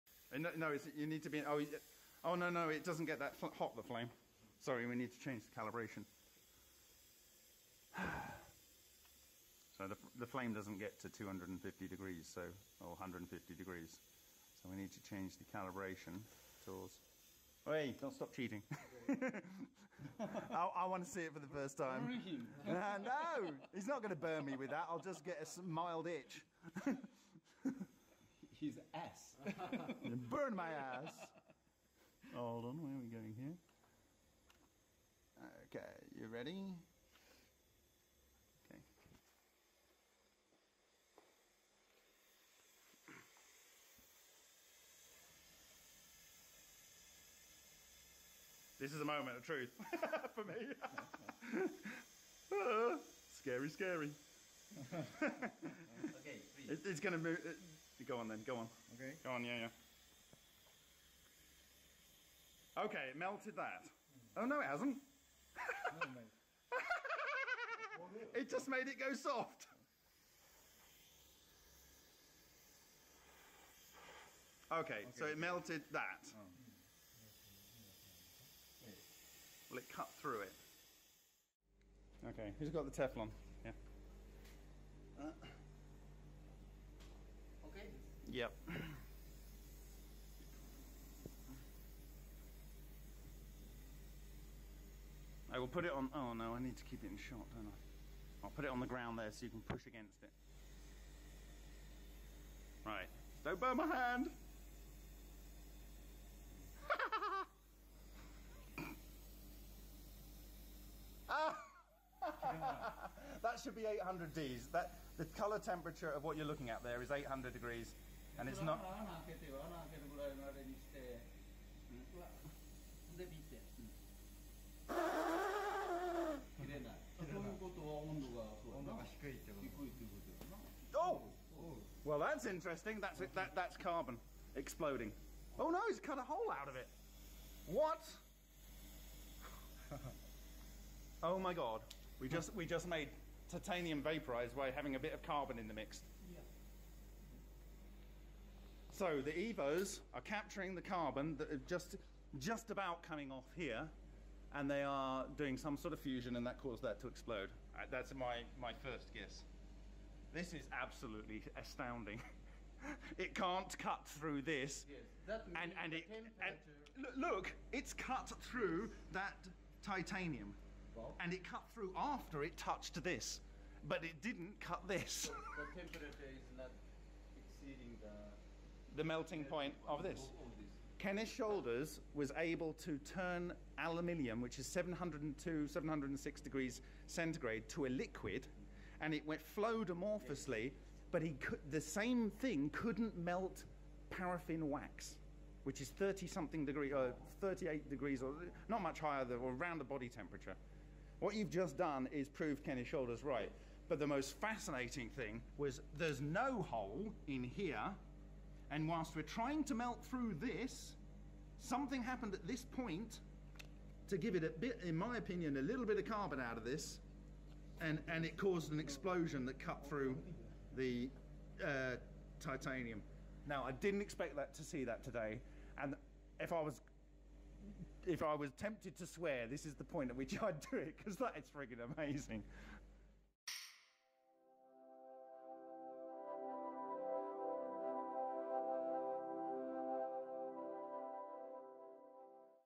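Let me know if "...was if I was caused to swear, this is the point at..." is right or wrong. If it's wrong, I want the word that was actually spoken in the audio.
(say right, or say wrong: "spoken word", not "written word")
wrong: "tempted", not "caused".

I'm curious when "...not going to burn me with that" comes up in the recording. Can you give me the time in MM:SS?
00:23.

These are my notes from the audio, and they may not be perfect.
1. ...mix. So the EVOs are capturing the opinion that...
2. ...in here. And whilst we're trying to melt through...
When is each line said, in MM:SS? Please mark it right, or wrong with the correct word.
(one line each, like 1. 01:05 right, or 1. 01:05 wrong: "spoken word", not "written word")
1. 02:25 wrong: "carbon", not "opinion"
2. 03:27 right.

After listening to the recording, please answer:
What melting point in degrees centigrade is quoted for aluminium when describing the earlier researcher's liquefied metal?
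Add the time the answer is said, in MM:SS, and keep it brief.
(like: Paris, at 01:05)
706, at 03:05.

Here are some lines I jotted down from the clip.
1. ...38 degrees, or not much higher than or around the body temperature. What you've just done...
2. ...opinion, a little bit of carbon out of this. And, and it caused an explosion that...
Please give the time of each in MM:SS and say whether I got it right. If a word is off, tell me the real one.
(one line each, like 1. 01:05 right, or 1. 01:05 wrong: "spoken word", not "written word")
1. 03:17 right
2. 03:35 right.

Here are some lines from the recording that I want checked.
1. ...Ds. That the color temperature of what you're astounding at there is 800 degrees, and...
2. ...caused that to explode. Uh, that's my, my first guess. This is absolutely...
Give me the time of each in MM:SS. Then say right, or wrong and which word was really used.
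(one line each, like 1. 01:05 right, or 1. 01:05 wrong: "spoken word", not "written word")
1. 01:54 wrong: "looking", not "astounding"
2. 02:36 right.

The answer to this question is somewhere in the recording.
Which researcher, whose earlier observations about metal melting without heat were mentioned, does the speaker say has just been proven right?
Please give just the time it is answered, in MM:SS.
03:00.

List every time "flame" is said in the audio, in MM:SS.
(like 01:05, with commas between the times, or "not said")
00:03, 00:10.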